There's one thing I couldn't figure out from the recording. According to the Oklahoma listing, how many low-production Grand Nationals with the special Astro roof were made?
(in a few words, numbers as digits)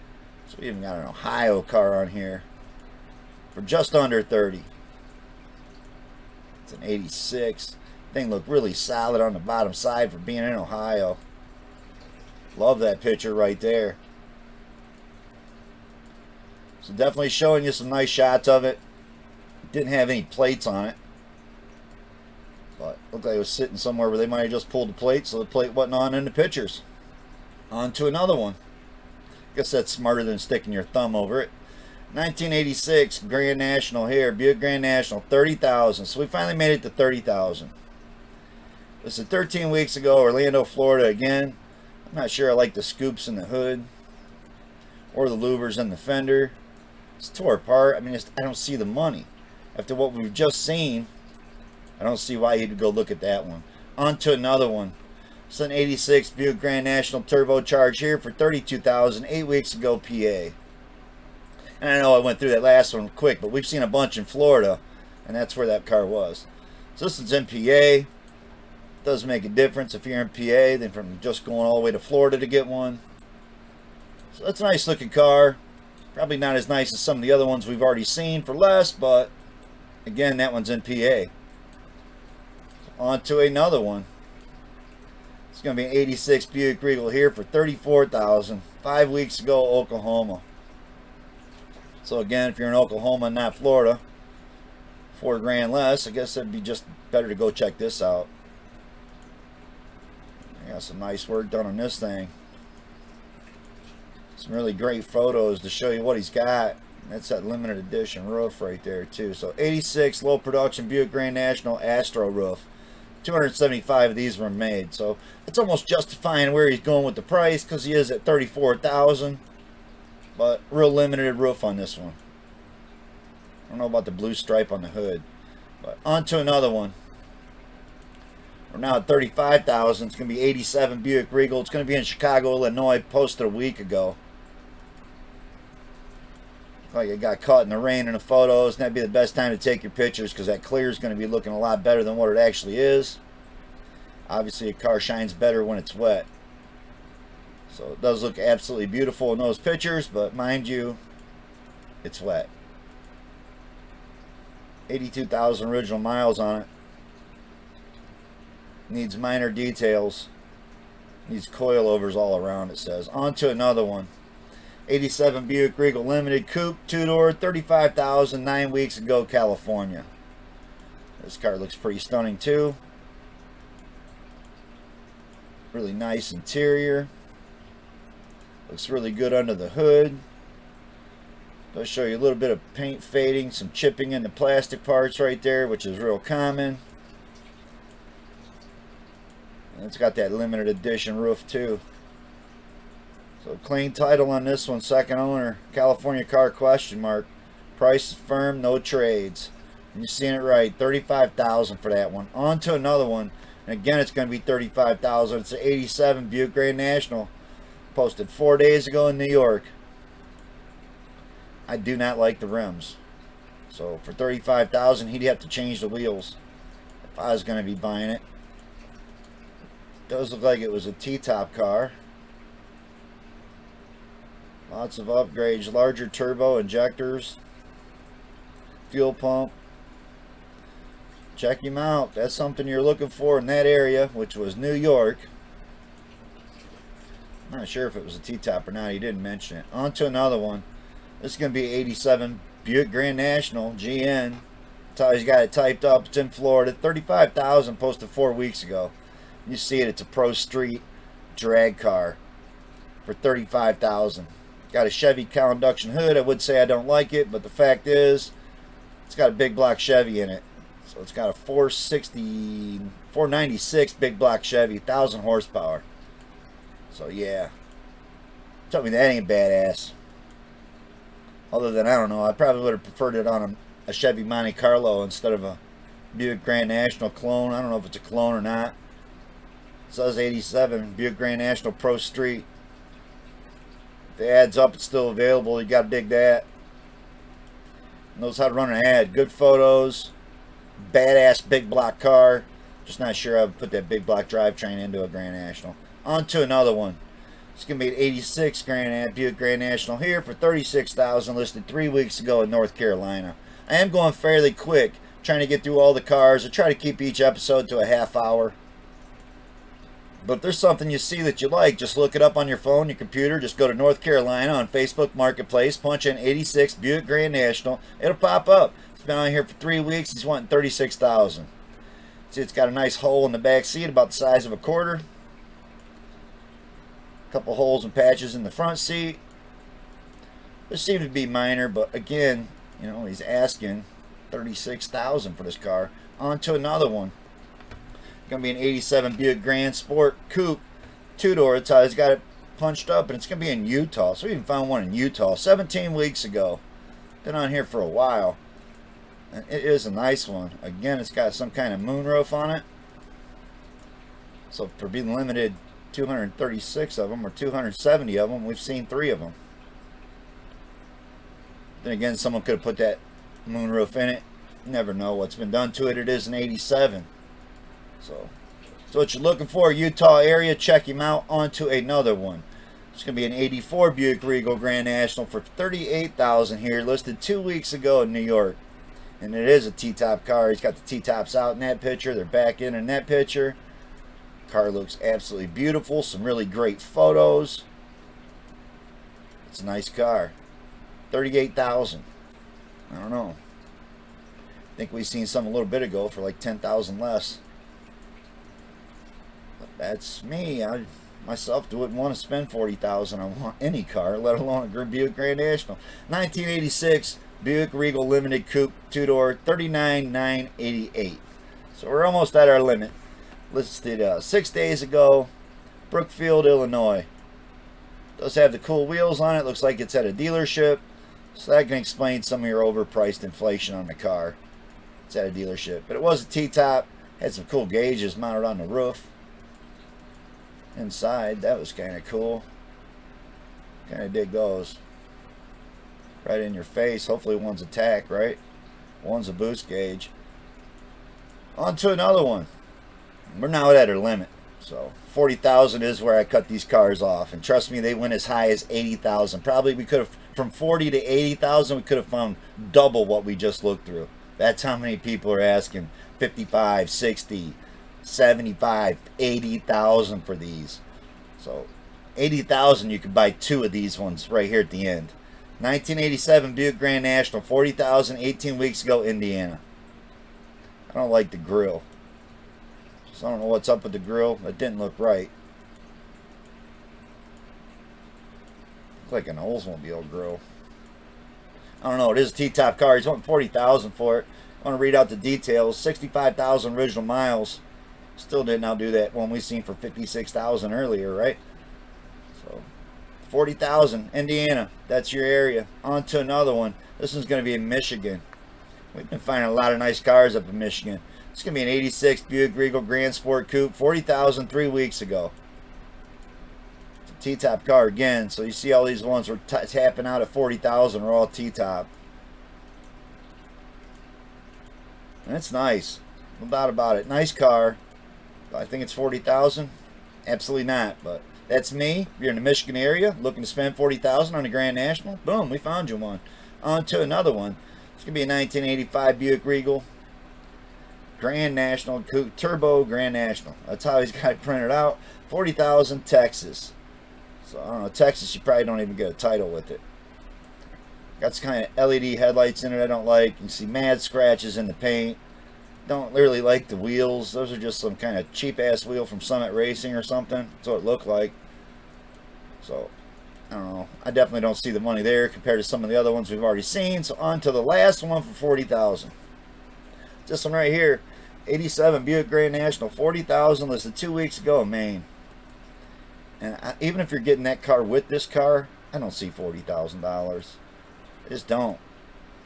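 275.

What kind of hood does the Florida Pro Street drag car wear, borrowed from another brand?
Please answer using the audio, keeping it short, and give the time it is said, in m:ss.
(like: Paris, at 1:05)
Chevy cowl induction hood, at 4:14.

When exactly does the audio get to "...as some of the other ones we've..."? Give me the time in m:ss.
1:16.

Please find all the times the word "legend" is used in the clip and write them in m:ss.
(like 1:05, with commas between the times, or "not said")
not said.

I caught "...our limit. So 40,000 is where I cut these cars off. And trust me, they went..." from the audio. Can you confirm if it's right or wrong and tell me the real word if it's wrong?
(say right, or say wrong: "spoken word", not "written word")
right.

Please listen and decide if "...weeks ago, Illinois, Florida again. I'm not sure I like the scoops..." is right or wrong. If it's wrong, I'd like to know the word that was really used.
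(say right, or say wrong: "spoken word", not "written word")
wrong: "Orlando", not "Illinois".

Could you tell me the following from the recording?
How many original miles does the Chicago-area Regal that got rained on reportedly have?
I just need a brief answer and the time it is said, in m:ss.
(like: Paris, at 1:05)
82,000, at 2:34.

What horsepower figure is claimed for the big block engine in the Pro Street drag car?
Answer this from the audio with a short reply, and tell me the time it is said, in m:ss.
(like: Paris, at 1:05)
1,000, at 4:24.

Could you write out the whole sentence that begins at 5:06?
I try to keep each episode to a half hour.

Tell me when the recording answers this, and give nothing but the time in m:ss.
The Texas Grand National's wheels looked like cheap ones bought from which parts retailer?
9:09.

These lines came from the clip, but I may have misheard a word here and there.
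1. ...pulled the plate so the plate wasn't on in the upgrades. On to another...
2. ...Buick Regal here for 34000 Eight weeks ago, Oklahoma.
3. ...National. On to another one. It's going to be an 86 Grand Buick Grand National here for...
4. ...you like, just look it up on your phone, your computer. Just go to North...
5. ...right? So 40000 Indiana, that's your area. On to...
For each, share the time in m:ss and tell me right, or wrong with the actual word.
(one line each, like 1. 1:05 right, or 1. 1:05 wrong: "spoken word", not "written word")
1. 0:24 wrong: "pictures", not "upgrades"
2. 1:26 wrong: "Five", not "Eight"
3. 4:55 right
4. 5:11 right
5. 8:11 right.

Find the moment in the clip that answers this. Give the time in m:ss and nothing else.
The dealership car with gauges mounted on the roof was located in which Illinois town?
6:55.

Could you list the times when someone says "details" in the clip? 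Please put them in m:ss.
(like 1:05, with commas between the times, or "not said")
2:39, 8:05.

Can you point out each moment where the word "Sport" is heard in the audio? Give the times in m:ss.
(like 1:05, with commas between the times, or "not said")
5:39, 8:23.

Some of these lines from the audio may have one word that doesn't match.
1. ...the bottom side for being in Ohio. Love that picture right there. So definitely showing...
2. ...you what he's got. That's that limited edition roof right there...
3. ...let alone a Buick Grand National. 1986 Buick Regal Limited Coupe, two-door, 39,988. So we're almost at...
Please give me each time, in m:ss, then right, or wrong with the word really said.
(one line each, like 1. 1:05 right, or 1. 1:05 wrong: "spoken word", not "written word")
1. 0:09 right
2. 1:45 right
3. 6:44 right.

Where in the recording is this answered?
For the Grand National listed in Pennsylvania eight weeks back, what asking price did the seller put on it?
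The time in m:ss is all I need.
0:58.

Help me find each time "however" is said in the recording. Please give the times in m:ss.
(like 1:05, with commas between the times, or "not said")
not said.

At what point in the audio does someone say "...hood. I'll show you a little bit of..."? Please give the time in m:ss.
2:59.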